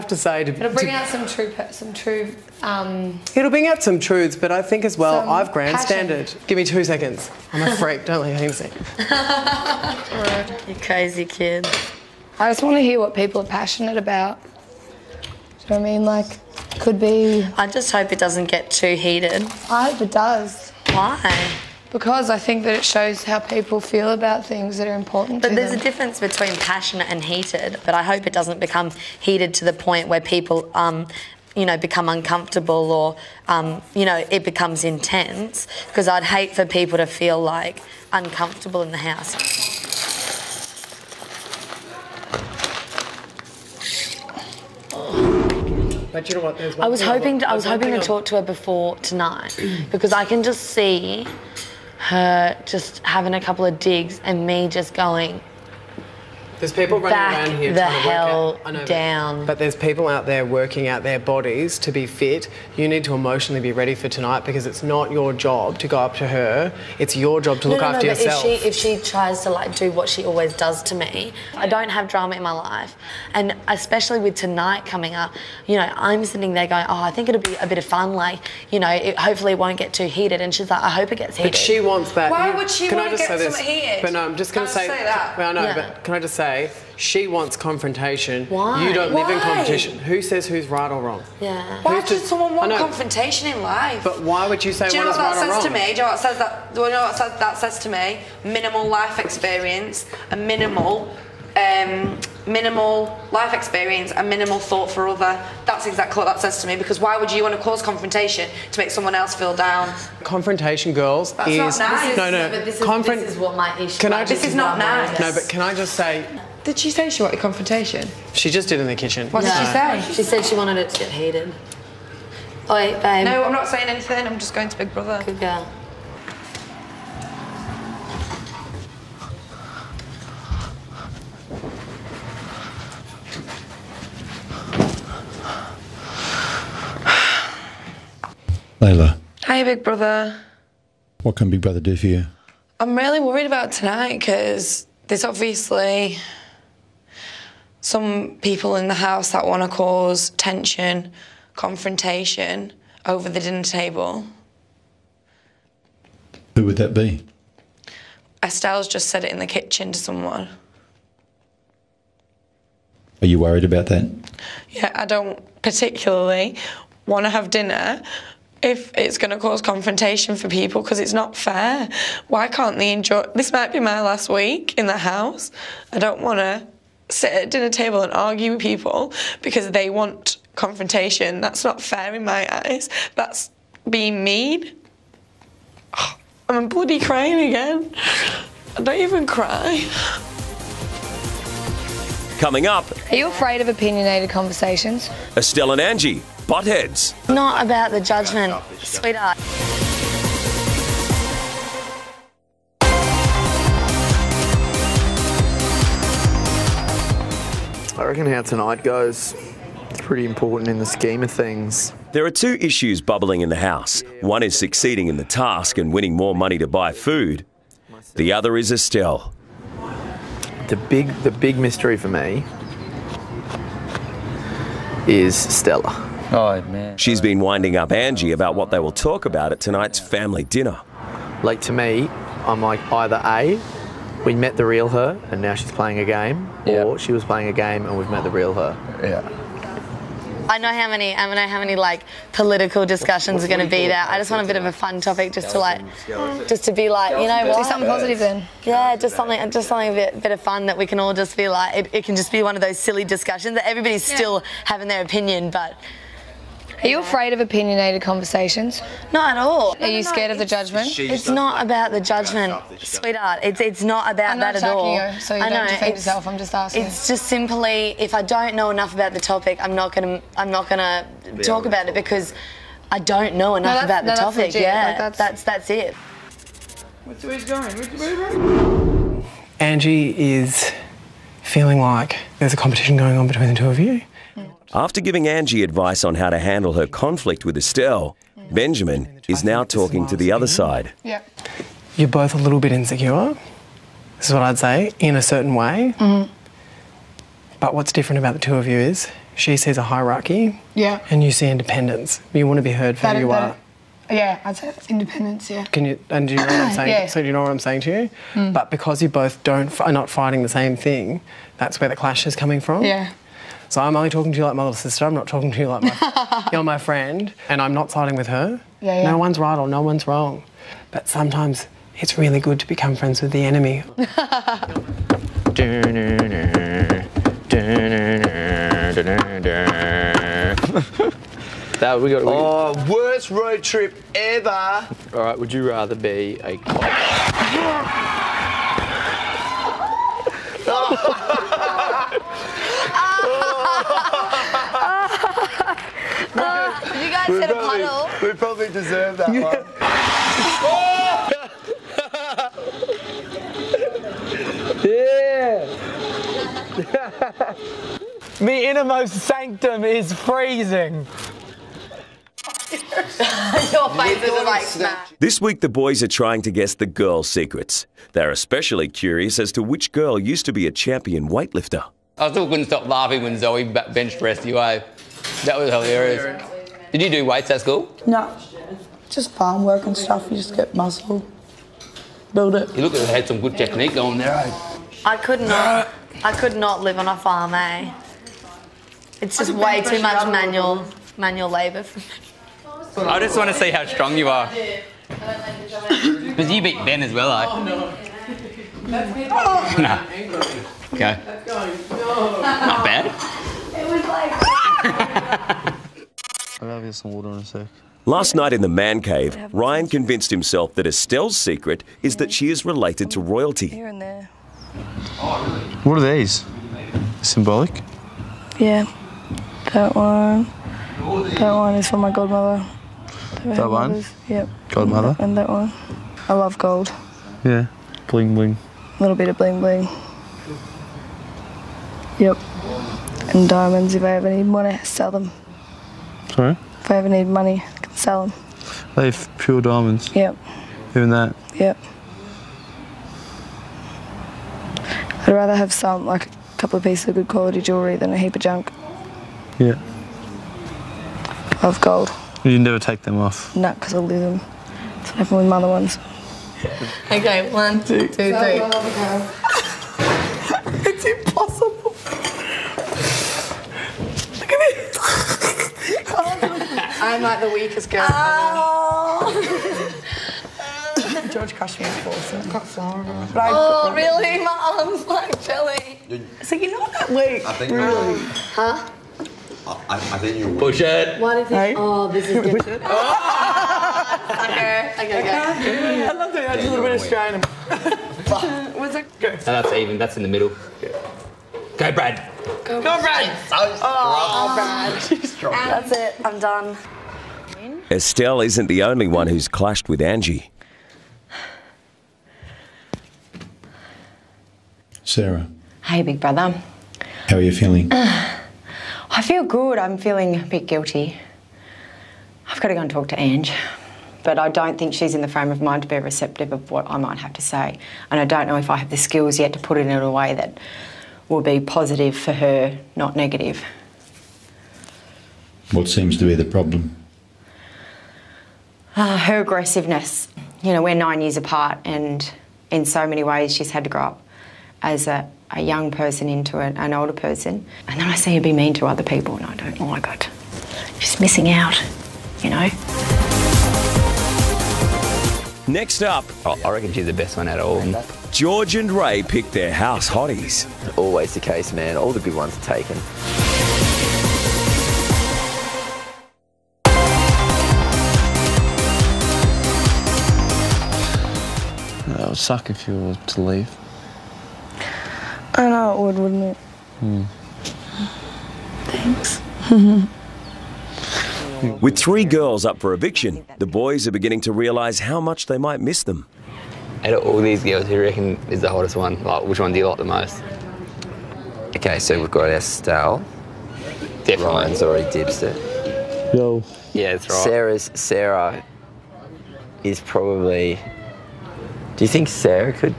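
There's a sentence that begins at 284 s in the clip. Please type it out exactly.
After giving Angie advice on how to handle her conflict with Estelle, Benjamin is now talking to the other side.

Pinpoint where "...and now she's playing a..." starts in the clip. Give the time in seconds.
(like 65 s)
235 s.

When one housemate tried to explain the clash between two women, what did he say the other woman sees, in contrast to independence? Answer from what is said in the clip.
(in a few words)
A hierarchy.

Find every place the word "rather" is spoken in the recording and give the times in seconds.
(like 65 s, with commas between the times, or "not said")
335 s, 445 s.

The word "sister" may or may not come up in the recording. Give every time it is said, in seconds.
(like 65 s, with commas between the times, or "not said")
314 s.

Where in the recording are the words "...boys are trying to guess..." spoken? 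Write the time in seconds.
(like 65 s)
365 s.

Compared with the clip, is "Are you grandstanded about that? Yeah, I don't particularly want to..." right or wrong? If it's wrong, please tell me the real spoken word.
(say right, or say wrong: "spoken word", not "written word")
wrong: "worried", not "grandstanded".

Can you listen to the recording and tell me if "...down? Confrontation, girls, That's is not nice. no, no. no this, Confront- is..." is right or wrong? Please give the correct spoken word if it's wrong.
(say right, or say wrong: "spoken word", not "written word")
right.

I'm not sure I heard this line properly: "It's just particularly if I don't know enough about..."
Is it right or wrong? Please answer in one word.
wrong.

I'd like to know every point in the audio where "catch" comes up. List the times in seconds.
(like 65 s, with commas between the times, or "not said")
not said.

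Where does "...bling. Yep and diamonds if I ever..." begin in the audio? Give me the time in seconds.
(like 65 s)
429 s.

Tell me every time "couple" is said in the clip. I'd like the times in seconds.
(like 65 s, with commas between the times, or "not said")
53 s, 446 s.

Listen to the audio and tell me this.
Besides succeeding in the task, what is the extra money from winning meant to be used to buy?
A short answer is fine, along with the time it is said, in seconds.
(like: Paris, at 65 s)
Food, at 216 s.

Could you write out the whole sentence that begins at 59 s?
But there's people out there working out their bodies to be fit.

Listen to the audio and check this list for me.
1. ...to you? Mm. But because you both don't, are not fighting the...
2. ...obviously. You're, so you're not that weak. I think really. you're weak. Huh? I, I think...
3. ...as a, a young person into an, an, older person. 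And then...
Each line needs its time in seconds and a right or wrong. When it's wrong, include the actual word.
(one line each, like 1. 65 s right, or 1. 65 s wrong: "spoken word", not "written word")
1. 307 s right
2. 475 s wrong: "jelly", not "obviously"
3. 534 s right.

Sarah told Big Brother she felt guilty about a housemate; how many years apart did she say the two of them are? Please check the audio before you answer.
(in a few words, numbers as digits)
9.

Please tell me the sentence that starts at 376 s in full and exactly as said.
Did you do weights at school?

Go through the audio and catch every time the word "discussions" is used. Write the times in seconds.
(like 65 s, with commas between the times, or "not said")
242 s, 253 s.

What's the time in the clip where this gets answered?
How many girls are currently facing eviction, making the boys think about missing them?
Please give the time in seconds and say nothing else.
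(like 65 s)
571 s.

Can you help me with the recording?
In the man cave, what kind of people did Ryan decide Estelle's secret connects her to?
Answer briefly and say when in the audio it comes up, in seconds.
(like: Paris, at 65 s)
Royalty, at 413 s.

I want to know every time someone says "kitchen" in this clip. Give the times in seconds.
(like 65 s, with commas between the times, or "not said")
118 s, 159 s.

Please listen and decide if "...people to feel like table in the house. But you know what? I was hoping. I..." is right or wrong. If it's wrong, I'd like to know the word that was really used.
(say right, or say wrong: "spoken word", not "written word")
wrong: "uncomfortable", not "table".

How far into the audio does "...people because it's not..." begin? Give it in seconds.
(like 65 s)
170 s.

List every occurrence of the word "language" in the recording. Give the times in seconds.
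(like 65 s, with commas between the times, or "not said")
not said.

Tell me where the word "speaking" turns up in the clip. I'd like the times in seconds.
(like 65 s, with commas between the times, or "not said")
not said.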